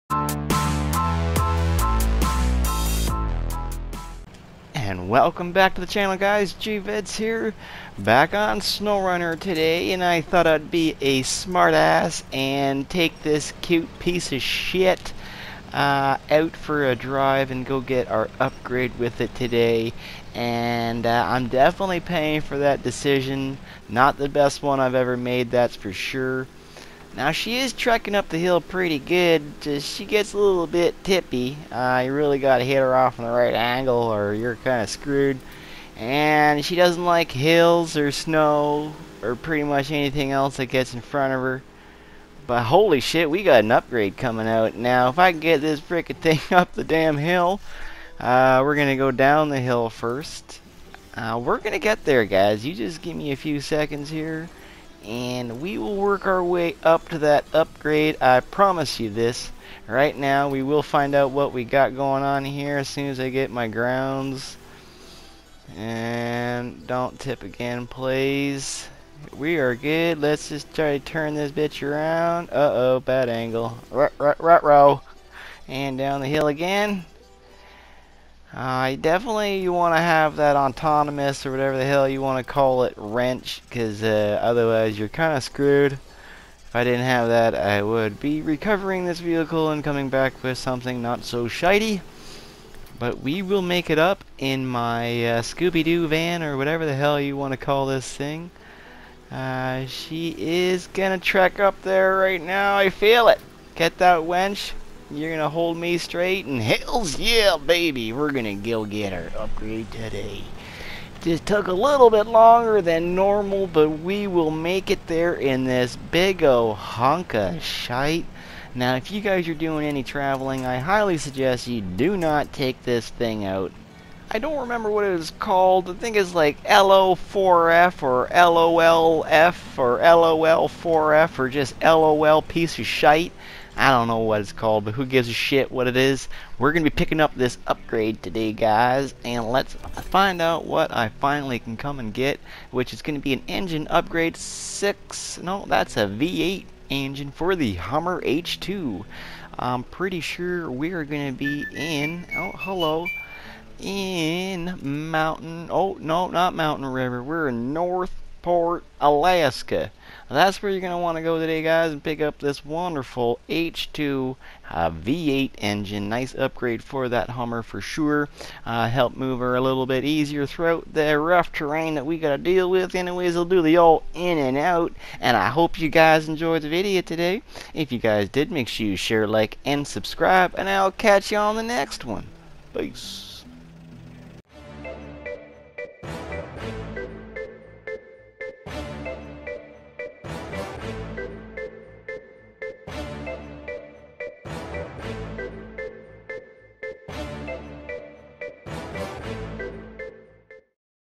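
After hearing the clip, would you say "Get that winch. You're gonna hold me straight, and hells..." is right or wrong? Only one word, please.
right.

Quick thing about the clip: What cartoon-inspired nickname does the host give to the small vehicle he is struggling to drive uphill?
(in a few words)
Scooby-Doo van.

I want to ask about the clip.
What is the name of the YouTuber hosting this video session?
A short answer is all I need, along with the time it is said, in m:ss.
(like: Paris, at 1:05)
GVids, at 0:06.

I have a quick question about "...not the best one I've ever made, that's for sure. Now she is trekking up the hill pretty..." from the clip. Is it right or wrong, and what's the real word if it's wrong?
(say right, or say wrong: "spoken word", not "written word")
right.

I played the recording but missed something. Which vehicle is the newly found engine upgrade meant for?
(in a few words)
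Hummer H2.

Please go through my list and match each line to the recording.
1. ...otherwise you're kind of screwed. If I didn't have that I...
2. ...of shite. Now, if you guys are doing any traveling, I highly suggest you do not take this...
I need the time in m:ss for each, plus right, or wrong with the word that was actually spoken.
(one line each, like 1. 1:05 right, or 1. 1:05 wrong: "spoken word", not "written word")
1. 1:24 right
2. 1:57 right.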